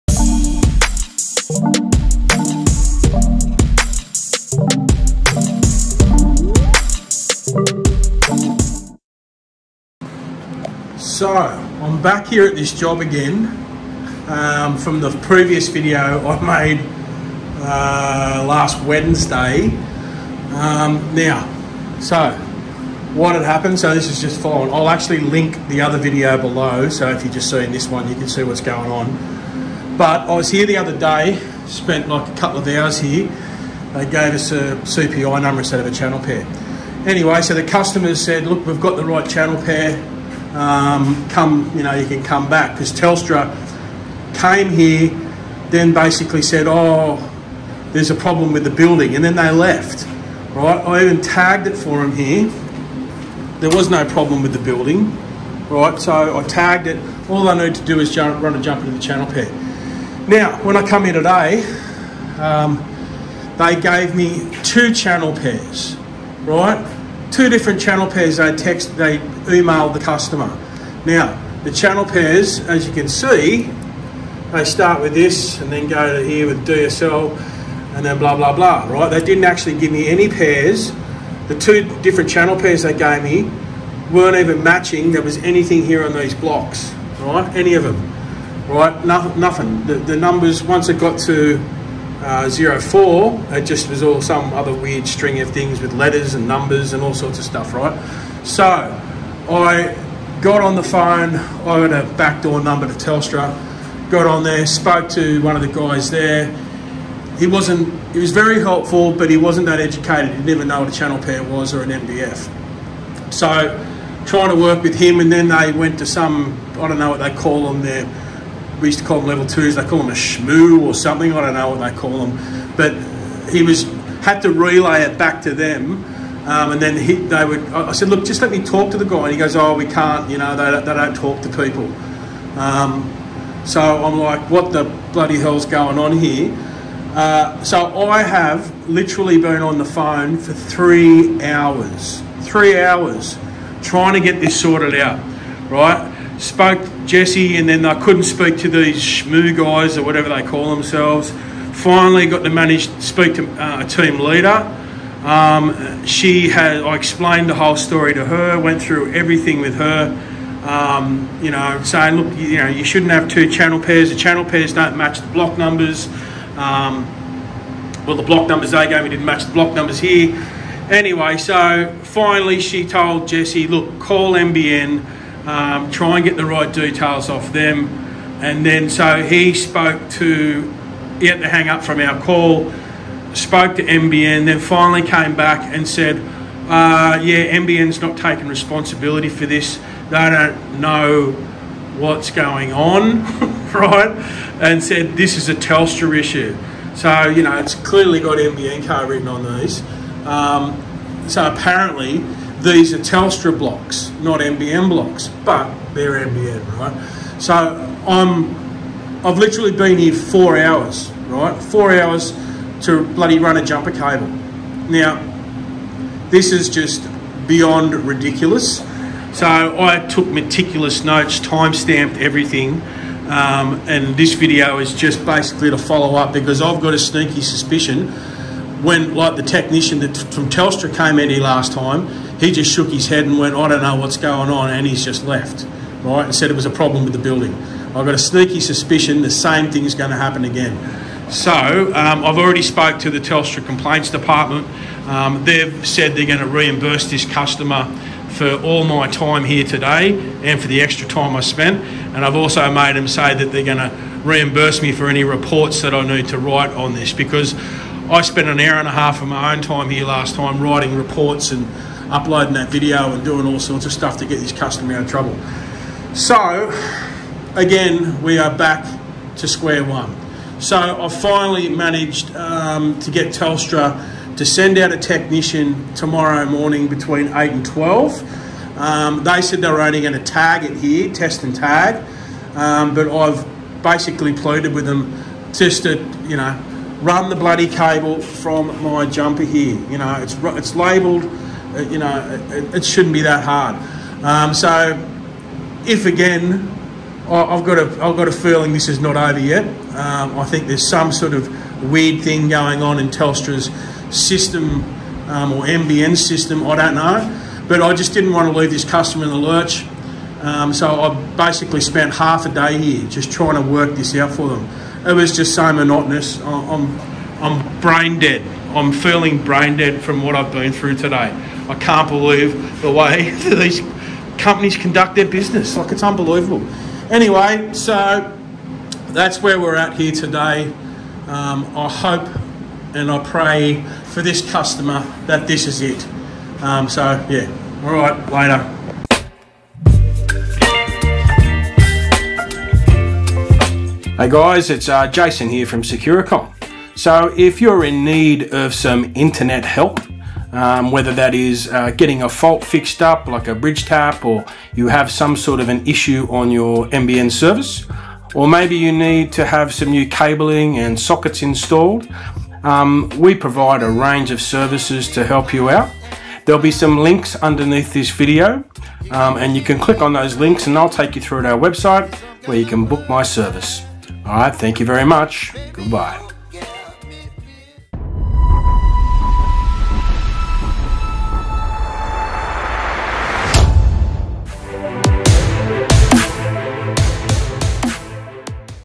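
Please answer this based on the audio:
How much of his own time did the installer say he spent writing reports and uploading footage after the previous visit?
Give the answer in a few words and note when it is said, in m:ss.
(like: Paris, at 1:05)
an hour and a half, at 4:18.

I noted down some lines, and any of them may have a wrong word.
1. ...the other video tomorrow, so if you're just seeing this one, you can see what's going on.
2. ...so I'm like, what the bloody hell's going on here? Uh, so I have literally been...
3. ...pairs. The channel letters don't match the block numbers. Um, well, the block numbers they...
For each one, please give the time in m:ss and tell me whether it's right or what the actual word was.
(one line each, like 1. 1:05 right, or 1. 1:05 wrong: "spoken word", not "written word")
1. 0:25 wrong: "below", not "tomorrow"
2. 2:13 right
3. 2:43 wrong: "pairs", not "letters".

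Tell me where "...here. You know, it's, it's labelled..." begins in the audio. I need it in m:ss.
4:49.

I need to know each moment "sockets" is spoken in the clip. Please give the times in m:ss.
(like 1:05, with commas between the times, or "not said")
6:00.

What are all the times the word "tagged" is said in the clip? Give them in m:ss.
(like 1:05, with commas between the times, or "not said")
0:51, 0:56.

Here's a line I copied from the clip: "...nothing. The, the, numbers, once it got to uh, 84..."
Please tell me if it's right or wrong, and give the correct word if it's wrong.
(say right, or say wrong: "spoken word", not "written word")
wrong: "04", not "84".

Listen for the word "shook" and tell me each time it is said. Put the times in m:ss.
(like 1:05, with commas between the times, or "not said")
3:52.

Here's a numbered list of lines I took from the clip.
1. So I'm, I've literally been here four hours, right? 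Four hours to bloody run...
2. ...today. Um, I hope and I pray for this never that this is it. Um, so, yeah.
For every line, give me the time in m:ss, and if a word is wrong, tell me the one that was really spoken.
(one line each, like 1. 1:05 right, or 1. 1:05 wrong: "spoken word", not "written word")
1. 3:27 right
2. 5:30 wrong: "customer", not "never".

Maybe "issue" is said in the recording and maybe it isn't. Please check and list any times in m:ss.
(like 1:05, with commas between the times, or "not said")
3:16, 5:55.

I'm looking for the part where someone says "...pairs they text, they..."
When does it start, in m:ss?
1:08.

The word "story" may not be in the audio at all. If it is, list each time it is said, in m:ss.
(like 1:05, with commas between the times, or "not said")
2:37.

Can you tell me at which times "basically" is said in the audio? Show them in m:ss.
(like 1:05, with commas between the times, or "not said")
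0:45, 3:45, 4:43, 5:11.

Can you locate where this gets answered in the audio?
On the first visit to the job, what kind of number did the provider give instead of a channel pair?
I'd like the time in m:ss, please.
0:34.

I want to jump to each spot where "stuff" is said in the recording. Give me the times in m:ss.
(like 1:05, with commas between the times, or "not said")
1:37, 4:23.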